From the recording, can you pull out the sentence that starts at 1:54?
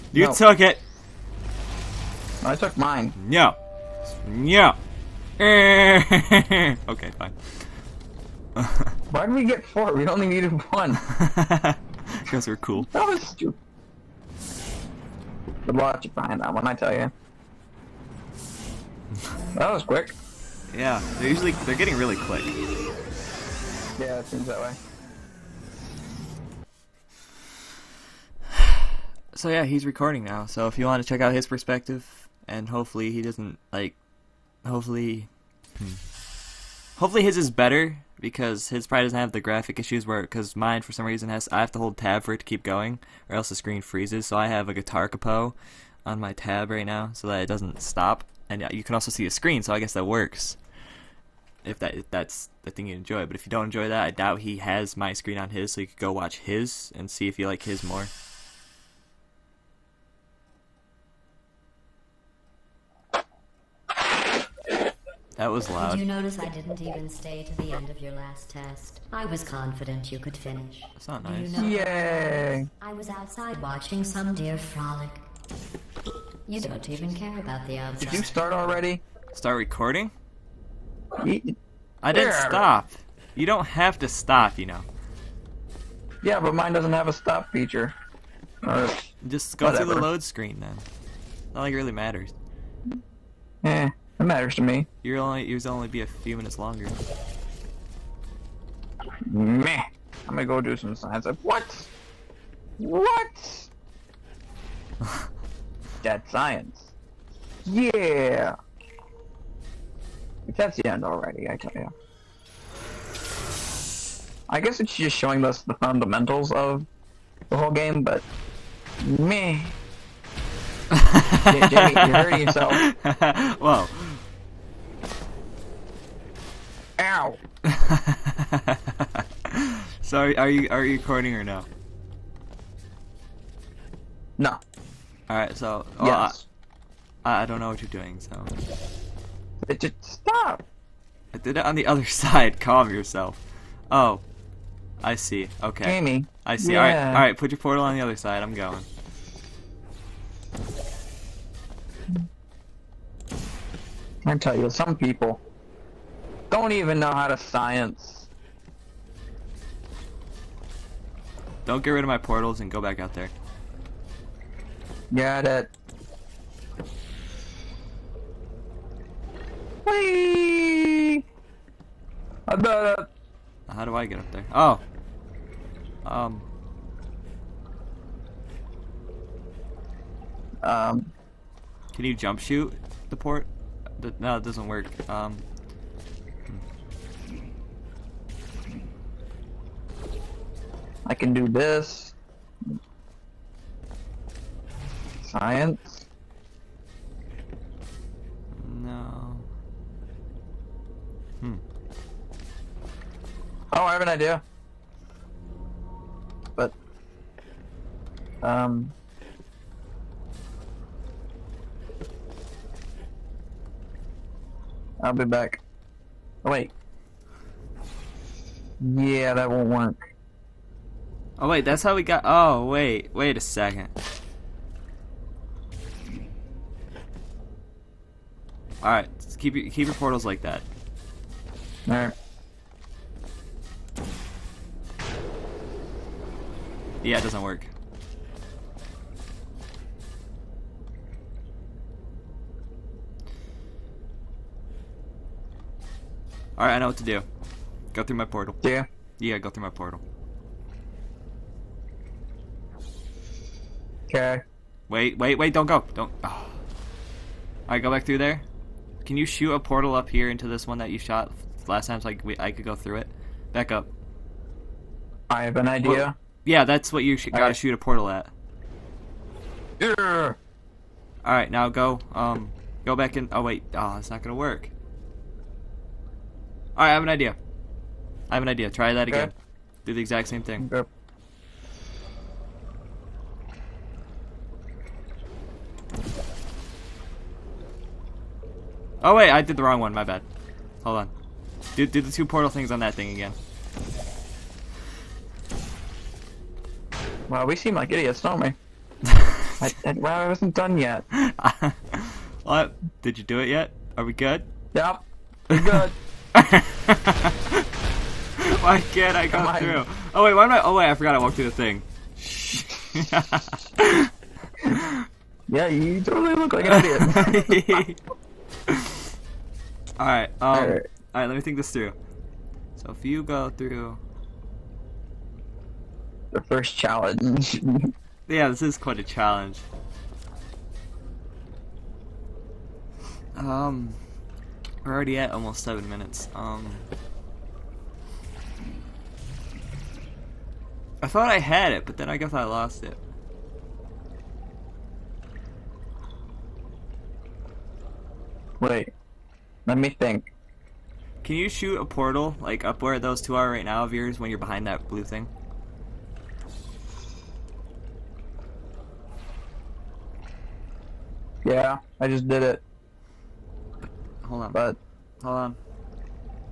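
I guess it's just showing us the fundamentals of the whole game, but meh.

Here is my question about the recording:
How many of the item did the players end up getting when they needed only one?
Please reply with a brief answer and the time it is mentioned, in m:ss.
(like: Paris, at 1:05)
4, at 0:09.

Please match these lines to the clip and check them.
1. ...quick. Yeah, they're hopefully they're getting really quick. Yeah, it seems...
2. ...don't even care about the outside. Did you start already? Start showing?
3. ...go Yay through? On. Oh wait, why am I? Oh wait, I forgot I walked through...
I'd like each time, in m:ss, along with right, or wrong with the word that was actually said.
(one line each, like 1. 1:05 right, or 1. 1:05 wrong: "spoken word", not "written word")
1. 0:19 wrong: "usually", not "hopefully"
2. 1:16 wrong: "recording", not "showing"
3. 5:09 wrong: "Come", not "Yay".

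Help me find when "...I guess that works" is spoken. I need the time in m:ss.
0:49.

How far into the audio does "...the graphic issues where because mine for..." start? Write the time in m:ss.
0:39.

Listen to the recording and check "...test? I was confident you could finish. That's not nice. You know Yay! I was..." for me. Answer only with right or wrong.
right.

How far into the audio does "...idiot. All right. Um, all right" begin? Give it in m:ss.
5:17.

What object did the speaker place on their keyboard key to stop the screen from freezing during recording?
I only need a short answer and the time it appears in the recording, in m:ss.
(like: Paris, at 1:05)
guitar capo, at 0:44.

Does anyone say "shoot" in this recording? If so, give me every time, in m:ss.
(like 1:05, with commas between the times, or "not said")
3:02, 4:19, 4:27, 5:51.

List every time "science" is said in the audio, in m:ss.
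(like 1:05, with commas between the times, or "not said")
1:40, 1:46, 2:37, 3:15.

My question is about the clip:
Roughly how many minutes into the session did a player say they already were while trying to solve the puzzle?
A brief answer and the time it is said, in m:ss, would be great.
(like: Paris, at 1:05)
7, at 5:35.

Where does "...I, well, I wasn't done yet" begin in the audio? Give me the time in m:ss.
4:59.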